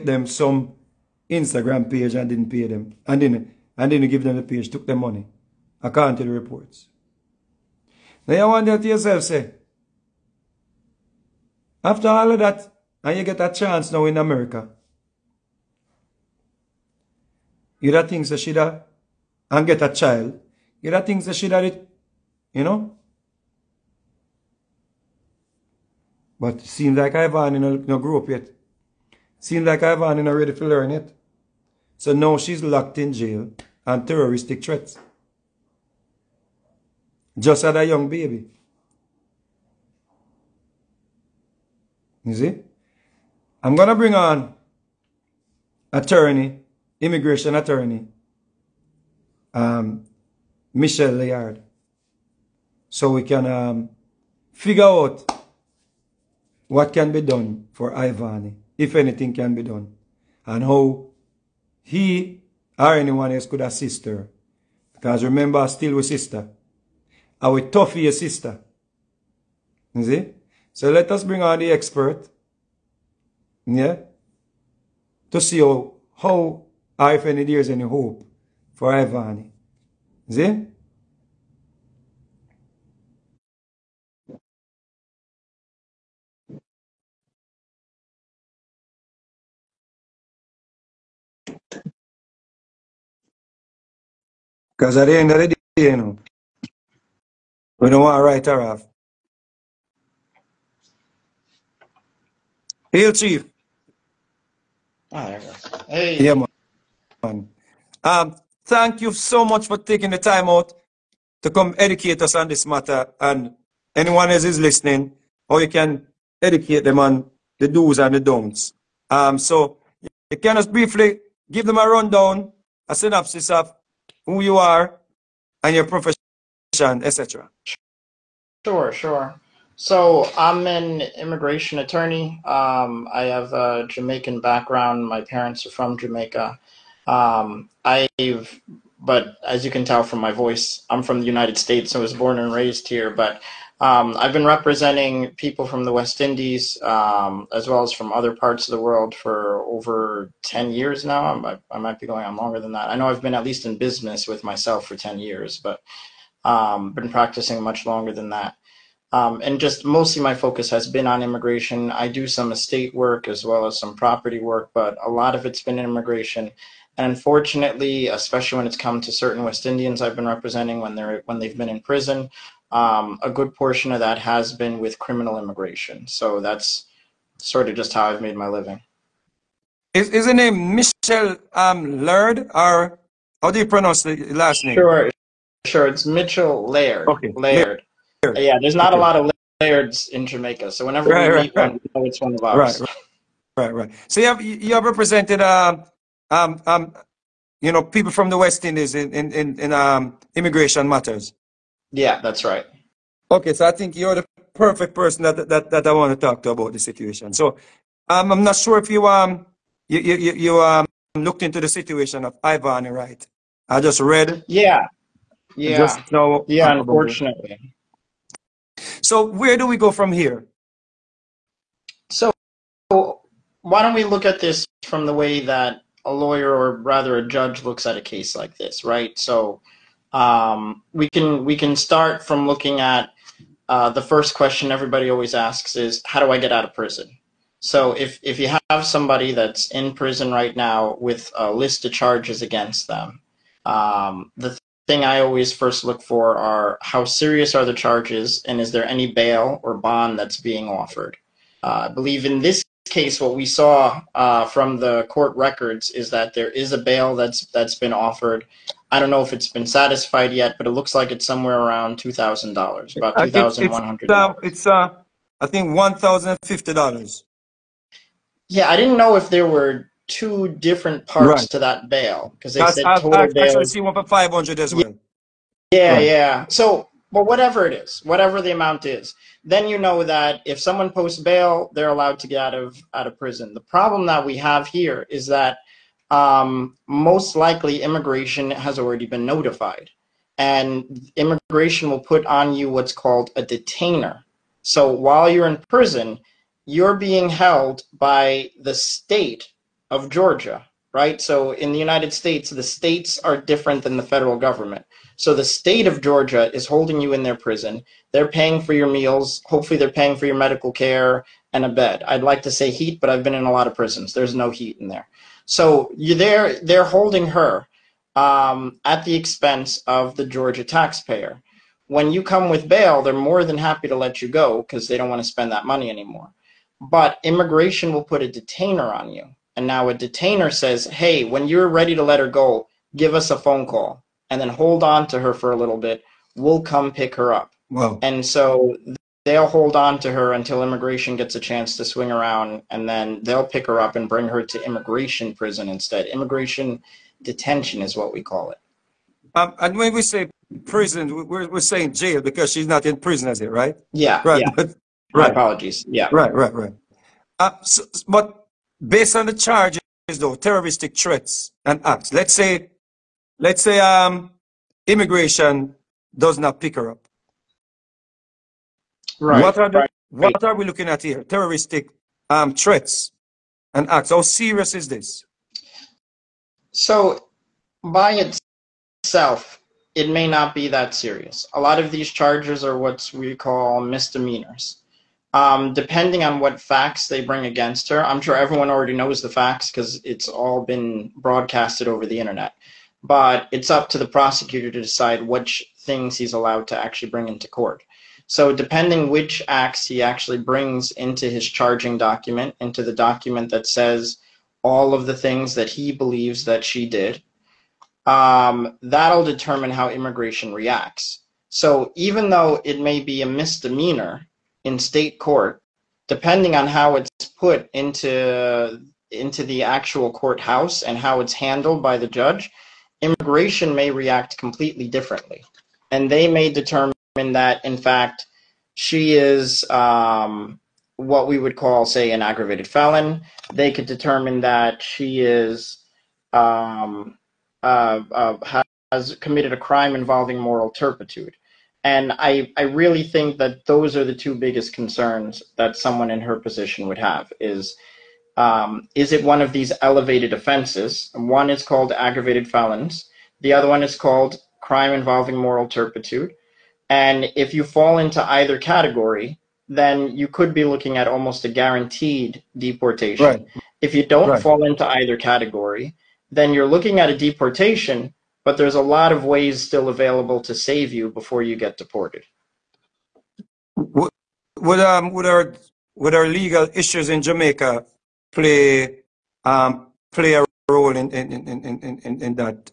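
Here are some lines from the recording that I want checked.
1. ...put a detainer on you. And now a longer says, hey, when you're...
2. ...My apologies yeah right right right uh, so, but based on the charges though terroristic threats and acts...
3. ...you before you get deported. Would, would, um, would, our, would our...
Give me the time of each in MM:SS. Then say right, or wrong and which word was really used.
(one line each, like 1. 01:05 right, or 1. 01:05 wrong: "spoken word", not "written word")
1. 05:28 wrong: "detainer", not "longer"
2. 05:55 right
3. 07:50 right.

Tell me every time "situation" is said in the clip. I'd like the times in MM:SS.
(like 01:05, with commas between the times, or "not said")
03:26, 03:31.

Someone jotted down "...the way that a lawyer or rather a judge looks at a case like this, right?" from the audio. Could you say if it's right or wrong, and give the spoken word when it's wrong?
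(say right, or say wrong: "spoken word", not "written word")
right.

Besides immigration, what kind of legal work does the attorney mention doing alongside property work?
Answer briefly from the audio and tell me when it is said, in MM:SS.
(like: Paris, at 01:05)
Estate work, at 02:42.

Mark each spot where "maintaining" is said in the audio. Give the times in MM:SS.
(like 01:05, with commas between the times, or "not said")
not said.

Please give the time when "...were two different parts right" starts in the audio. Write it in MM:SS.
04:29.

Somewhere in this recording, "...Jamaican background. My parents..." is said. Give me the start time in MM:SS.
02:13.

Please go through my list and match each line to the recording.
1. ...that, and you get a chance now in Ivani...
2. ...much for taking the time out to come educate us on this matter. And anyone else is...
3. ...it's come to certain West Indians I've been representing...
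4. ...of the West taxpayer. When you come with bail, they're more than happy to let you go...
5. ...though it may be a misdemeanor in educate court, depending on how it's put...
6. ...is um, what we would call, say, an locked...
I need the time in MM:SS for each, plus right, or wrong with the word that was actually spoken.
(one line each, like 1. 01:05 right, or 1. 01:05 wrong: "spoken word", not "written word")
1. 00:12 wrong: "America", not "Ivani"
2. 01:49 right
3. 02:48 right
4. 05:19 wrong: "Georgia", not "West"
5. 06:52 wrong: "state", not "educate"
6. 07:09 wrong: "aggravated", not "locked".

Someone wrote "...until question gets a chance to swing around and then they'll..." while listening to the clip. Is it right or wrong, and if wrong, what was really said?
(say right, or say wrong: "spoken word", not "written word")
wrong: "immigration", not "question".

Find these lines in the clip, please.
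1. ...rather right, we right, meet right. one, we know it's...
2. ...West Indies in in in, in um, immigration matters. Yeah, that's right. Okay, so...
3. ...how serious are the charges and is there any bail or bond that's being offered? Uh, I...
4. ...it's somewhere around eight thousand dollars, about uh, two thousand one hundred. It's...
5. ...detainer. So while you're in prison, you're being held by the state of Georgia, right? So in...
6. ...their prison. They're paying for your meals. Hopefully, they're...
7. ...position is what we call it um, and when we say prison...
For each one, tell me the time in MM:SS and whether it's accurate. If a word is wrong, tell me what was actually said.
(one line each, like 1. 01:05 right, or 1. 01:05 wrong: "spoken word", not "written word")
1. 03:10 wrong: "whenever", not "rather"
2. 03:18 right
3. 04:06 right
4. 04:21 wrong: "two", not "eight"
5. 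04:53 right
6. 05:07 right
7. 05:47 wrong: "detention", not "position".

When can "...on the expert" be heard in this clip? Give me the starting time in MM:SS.
01:11.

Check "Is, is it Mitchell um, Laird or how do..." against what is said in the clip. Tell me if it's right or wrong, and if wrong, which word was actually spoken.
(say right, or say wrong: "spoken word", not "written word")
right.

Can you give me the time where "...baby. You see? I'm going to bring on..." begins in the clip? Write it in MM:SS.
00:38.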